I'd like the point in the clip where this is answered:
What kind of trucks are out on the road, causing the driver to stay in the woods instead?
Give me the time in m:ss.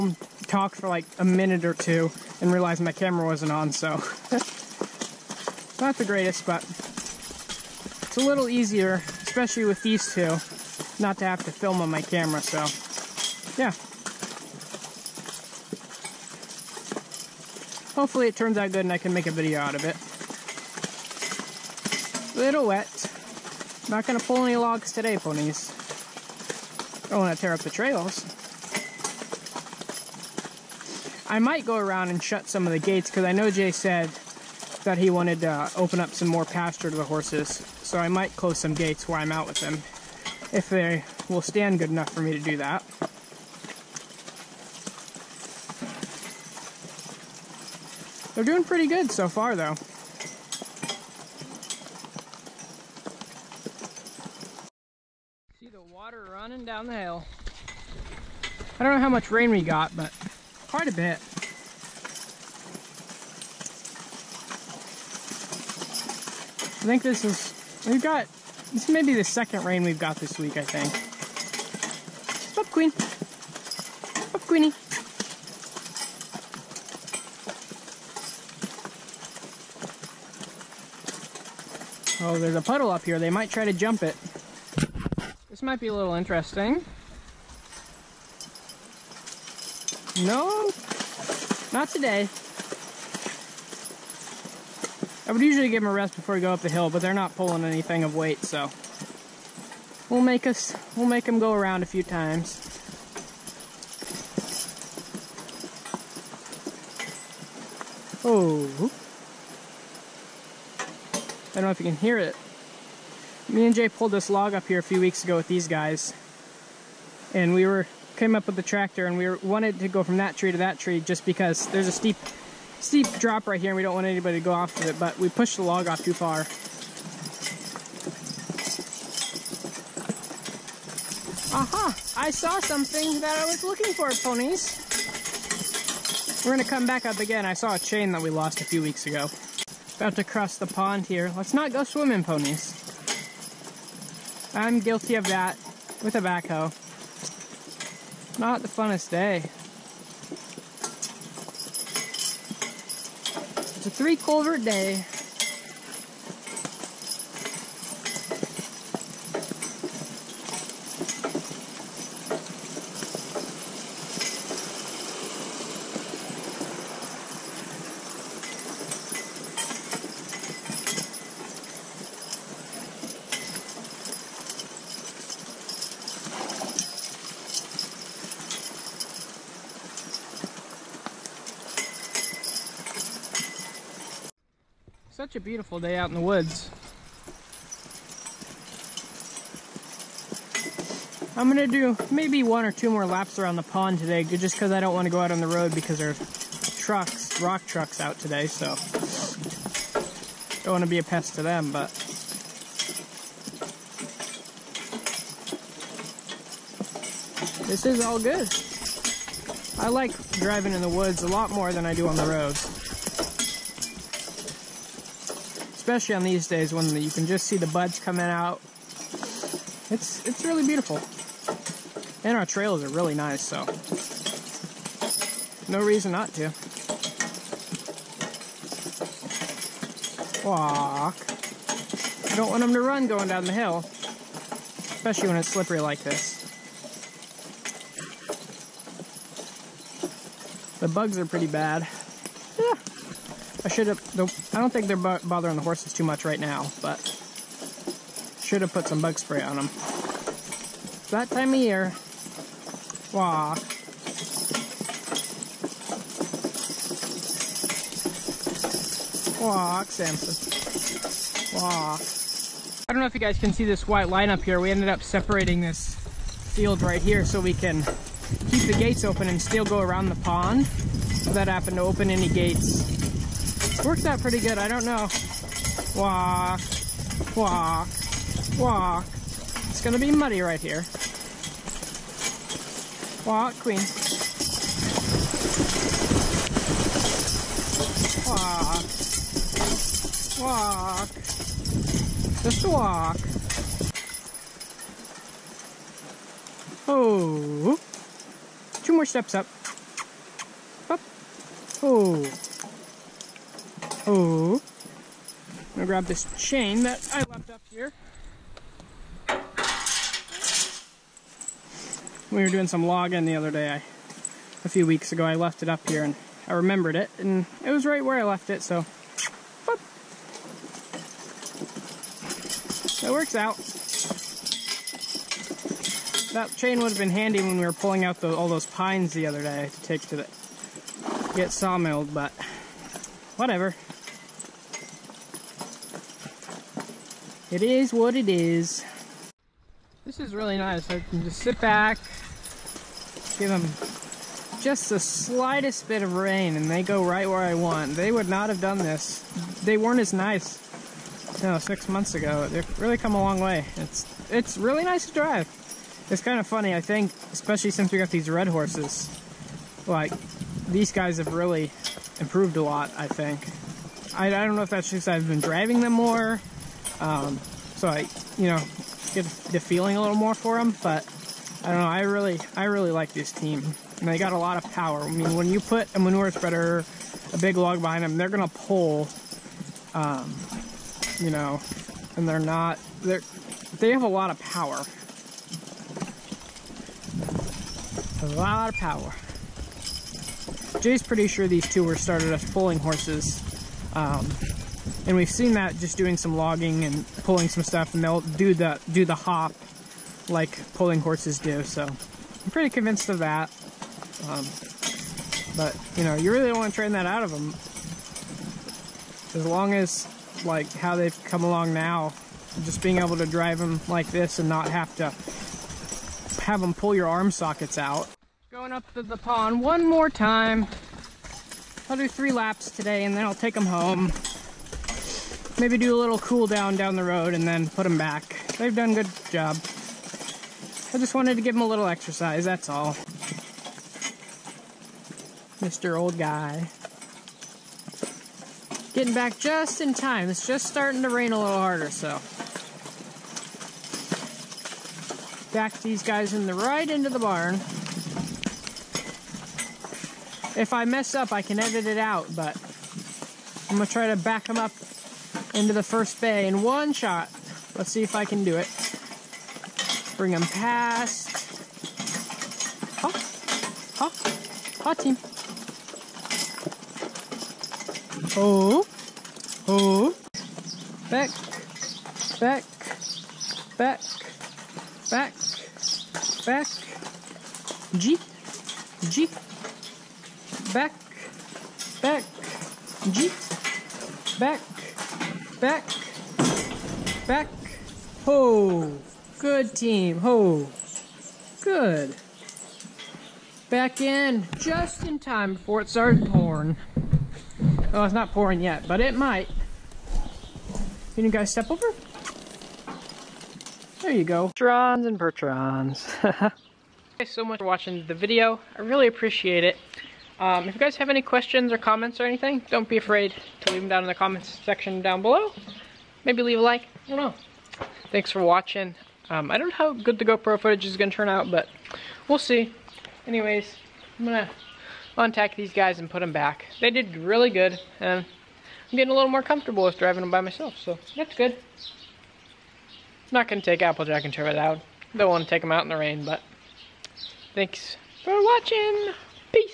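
3:17.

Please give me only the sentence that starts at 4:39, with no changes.
It's gonna be muddy right here.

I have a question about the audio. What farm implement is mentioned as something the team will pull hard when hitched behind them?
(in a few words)
Manure spreader.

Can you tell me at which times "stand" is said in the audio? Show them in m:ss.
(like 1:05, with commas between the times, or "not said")
0:41.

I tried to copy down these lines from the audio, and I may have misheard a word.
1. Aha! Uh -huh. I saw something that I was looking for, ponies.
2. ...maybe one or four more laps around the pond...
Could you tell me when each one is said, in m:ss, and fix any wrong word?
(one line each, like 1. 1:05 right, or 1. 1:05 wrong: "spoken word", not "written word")
1. 2:11 right
2. 3:12 wrong: "two", not "four".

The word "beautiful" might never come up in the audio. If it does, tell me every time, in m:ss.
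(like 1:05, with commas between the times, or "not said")
3:05, 3:40.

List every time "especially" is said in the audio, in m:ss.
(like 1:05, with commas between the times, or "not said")
0:09, 3:35, 3:53, 5:57.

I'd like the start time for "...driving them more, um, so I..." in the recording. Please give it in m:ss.
6:05.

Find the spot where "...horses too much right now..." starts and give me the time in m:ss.
4:05.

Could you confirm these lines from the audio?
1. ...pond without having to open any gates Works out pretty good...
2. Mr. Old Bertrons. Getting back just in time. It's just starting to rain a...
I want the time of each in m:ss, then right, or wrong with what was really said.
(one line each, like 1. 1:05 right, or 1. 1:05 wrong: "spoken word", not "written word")
1. 4:30 right
2. 7:15 wrong: "Guy", not "Bertrons".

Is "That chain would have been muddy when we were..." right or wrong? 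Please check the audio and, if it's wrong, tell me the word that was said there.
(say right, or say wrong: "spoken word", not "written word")
wrong: "handy", not "muddy".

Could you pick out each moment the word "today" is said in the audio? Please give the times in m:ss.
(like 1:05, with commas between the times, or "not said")
0:24, 1:31, 3:13, 3:18, 7:02.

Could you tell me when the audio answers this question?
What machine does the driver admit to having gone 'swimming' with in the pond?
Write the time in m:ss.
2:26.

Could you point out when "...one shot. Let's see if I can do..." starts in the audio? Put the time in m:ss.
7:36.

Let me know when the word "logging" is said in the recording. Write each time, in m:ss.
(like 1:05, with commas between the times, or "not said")
5:12, 6:36.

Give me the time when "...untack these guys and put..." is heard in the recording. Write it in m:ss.
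8:45.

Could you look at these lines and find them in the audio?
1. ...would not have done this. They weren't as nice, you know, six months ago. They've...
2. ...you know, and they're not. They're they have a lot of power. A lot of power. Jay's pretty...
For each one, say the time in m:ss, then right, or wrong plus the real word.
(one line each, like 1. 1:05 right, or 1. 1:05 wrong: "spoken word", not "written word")
1. 5:48 right
2. 6:21 right.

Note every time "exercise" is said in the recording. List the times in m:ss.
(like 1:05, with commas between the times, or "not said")
7:11.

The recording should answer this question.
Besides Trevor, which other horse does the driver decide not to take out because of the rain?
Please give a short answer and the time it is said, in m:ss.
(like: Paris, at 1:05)
Applejack, at 8:53.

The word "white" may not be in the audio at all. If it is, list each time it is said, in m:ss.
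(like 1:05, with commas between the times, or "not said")
4:23.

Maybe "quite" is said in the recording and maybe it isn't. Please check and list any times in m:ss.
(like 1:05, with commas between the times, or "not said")
1:00.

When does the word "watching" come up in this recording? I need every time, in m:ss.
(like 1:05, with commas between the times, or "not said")
8:27, 8:38, 8:58.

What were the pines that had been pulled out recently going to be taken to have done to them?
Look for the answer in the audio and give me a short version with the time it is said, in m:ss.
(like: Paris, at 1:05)
Sawmilled, at 5:31.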